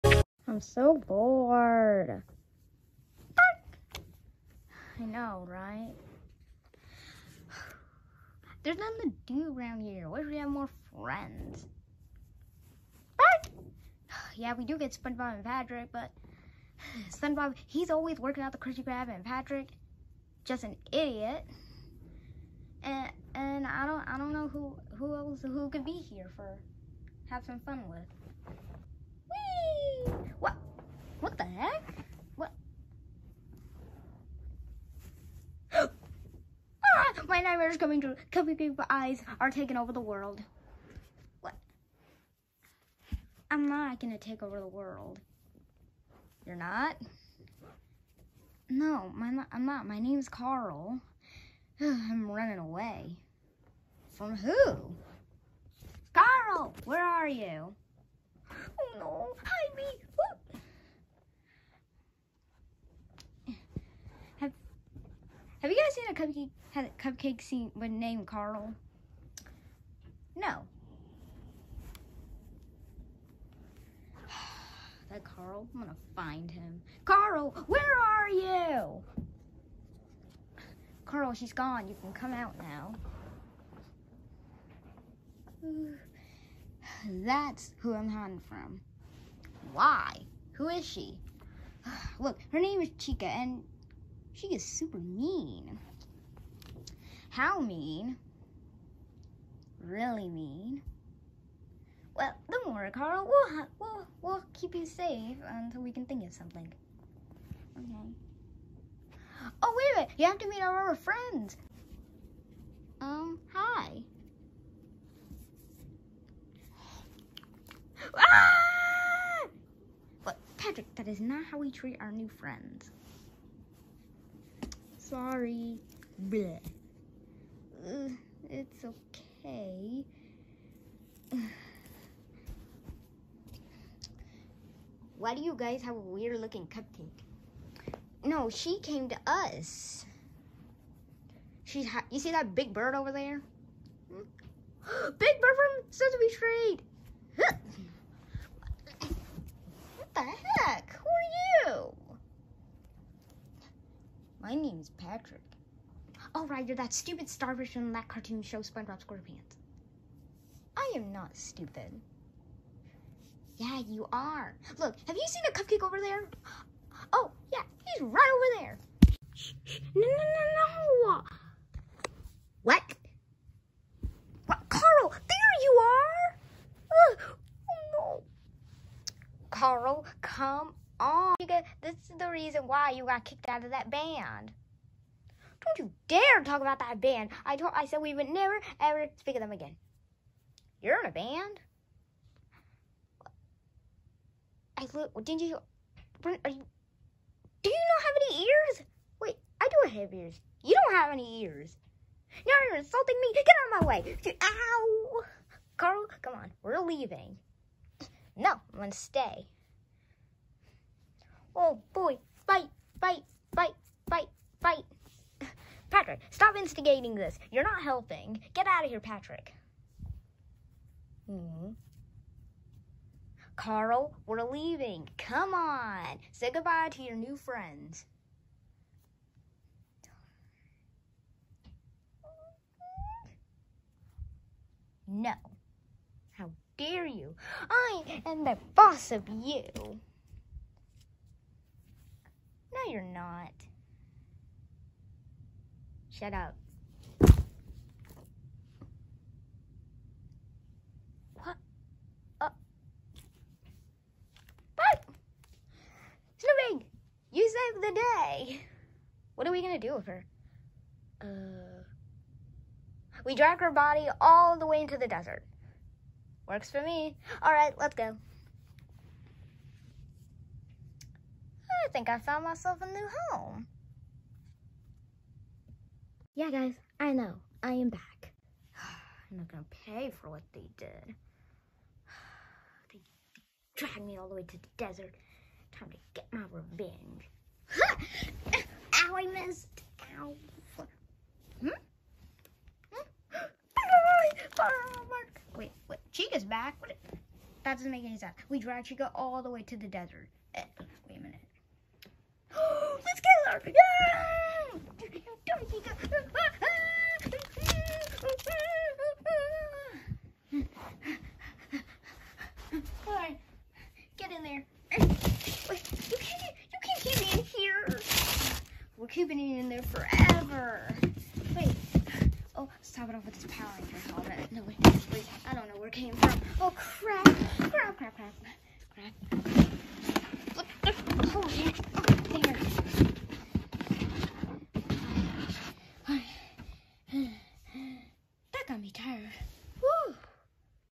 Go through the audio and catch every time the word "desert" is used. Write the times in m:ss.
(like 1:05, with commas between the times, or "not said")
4:25, 4:44, 4:59.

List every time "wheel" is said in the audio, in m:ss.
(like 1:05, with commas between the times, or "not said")
not said.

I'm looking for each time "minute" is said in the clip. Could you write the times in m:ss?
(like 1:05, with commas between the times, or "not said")
1:50.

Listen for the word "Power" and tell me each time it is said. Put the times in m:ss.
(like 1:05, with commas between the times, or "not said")
5:23.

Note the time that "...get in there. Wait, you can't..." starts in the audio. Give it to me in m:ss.
5:14.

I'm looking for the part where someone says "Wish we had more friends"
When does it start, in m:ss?
0:10.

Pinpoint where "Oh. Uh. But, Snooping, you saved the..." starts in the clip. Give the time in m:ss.
4:12.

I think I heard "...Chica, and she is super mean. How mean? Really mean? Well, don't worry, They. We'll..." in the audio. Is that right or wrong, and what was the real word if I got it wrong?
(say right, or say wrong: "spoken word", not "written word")
wrong: "Carl", not "They".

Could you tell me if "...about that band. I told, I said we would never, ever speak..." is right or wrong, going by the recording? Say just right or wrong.
right.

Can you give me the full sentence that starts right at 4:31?
I think I found myself a new home.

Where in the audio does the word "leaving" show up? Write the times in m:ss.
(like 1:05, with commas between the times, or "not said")
3:26, 3:44.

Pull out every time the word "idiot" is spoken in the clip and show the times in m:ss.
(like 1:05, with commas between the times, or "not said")
0:20.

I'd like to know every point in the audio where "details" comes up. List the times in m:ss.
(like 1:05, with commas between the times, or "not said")
not said.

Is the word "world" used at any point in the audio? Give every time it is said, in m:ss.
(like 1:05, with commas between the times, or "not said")
0:40, 0:44.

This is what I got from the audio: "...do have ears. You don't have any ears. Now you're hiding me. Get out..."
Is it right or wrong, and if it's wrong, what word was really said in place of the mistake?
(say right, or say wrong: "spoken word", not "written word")
wrong: "insulting", not "hiding".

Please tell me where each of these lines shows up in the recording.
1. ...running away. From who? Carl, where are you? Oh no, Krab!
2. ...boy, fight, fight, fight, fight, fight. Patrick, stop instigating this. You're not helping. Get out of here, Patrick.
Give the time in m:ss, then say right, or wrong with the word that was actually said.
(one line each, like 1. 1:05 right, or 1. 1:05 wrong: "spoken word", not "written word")
1. 0:52 wrong: "Ivy", not "Krab"
2. 3:31 right.